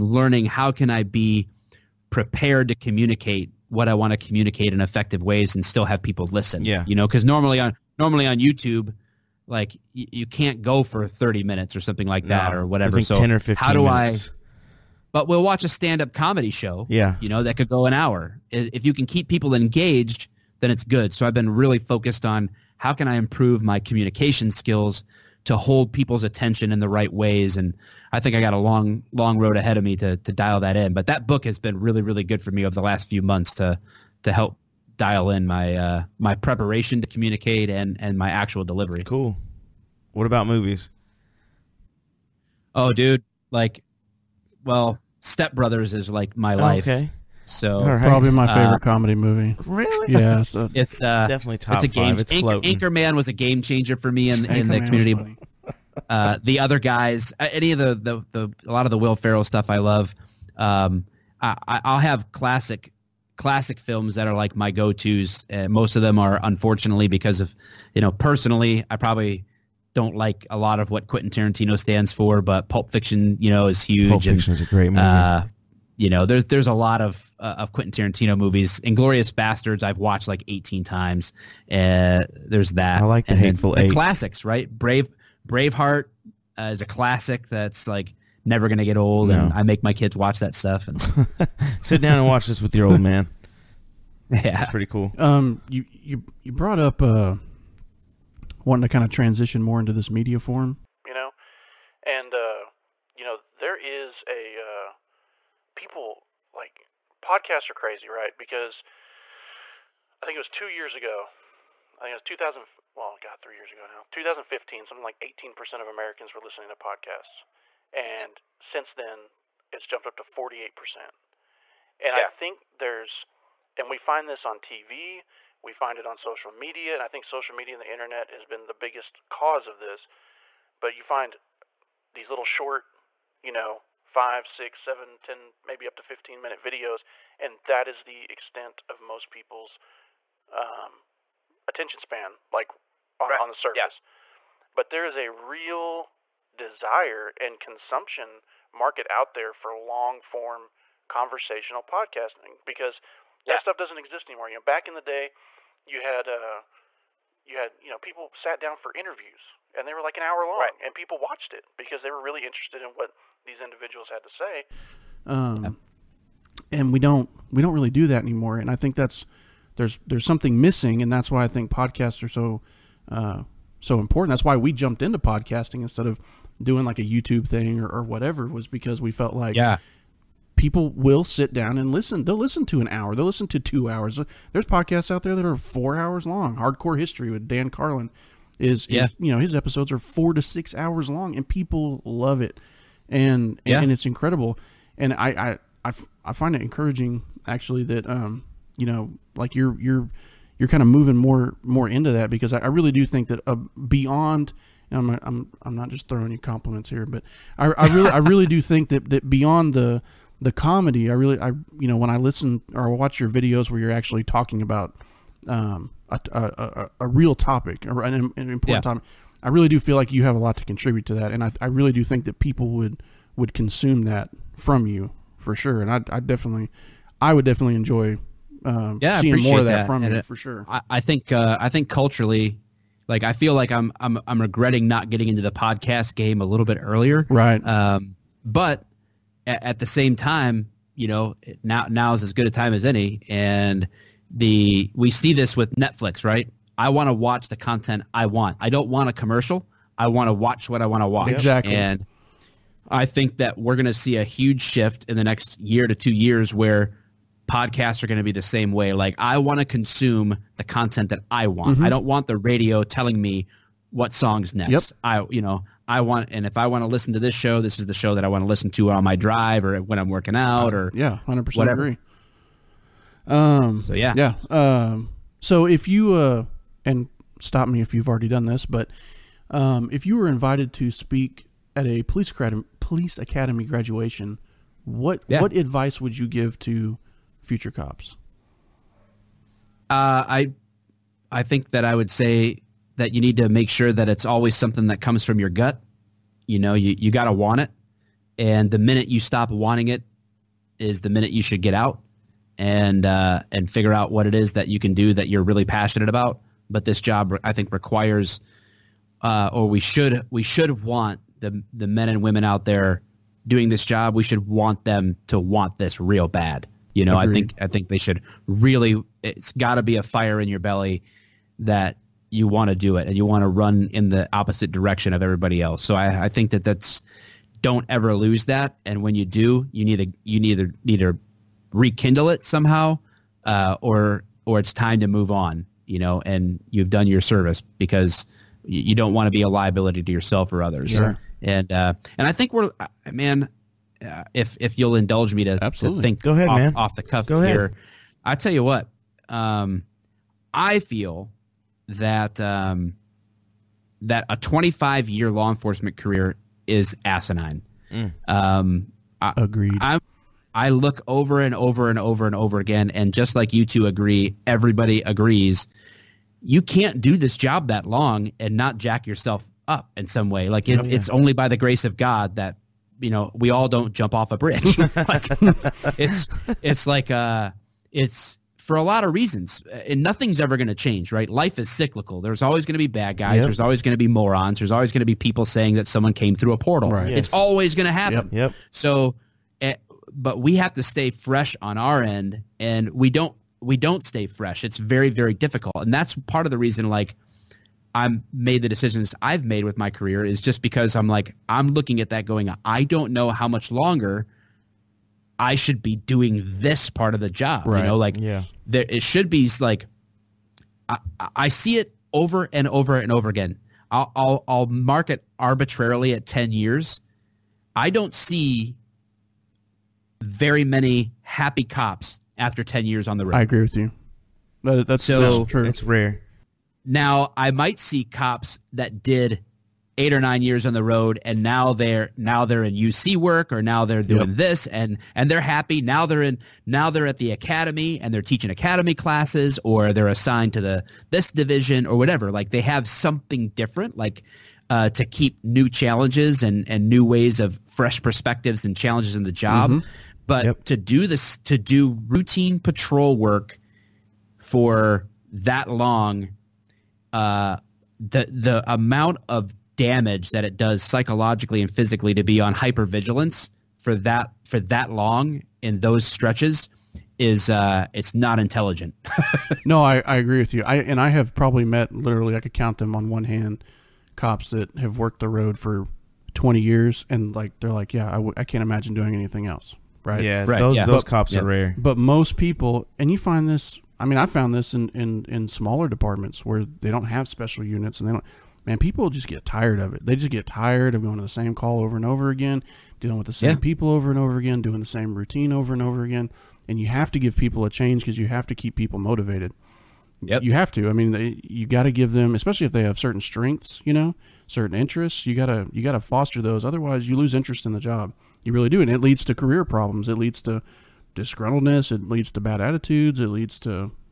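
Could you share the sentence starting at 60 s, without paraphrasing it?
Um, I, I'll have classic classic films that are like my go-tos.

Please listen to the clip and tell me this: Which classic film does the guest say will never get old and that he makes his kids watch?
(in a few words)
Braveheart.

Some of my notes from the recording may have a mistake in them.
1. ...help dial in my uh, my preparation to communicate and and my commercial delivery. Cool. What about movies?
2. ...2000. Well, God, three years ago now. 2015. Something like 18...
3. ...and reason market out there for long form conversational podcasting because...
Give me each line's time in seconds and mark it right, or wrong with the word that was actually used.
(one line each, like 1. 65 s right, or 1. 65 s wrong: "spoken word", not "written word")
1. 34 s wrong: "actual", not "commercial"
2. 112 s right
3. 147 s wrong: "consumption", not "reason".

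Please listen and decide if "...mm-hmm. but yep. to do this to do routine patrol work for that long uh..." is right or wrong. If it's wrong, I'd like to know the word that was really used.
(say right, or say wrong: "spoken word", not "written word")
right.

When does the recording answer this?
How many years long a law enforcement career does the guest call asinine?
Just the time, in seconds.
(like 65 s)
354 s.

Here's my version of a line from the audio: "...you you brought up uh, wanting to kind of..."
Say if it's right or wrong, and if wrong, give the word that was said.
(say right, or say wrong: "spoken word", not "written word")
right.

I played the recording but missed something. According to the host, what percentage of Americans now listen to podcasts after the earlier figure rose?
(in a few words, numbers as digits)
48%.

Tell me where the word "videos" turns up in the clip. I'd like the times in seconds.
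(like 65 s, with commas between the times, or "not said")
136 s, 213 s.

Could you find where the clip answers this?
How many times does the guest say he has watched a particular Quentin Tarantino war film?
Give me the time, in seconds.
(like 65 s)
80 s.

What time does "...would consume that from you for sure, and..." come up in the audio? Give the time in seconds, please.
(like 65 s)
223 s.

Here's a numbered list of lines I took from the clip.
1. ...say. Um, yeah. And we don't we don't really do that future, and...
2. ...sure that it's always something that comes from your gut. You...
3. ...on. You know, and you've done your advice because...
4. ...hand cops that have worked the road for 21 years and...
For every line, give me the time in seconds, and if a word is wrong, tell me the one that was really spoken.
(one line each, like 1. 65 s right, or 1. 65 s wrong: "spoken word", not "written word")
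1. 164 s wrong: "anymore", not "future"
2. 293 s right
3. 335 s wrong: "service", not "advice"
4. 473 s wrong: "20", not "21".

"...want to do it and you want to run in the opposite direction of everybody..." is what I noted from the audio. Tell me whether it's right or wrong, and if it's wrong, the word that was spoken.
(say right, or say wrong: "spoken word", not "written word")
right.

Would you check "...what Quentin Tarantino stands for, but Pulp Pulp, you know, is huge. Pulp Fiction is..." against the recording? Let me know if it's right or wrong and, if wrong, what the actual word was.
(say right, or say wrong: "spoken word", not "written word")
wrong: "Fiction", not "Pulp".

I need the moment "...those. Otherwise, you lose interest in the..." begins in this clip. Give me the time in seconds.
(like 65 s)
506 s.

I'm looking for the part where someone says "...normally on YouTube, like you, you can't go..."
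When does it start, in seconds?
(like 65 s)
7 s.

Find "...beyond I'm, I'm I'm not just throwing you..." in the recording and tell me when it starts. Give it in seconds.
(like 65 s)
203 s.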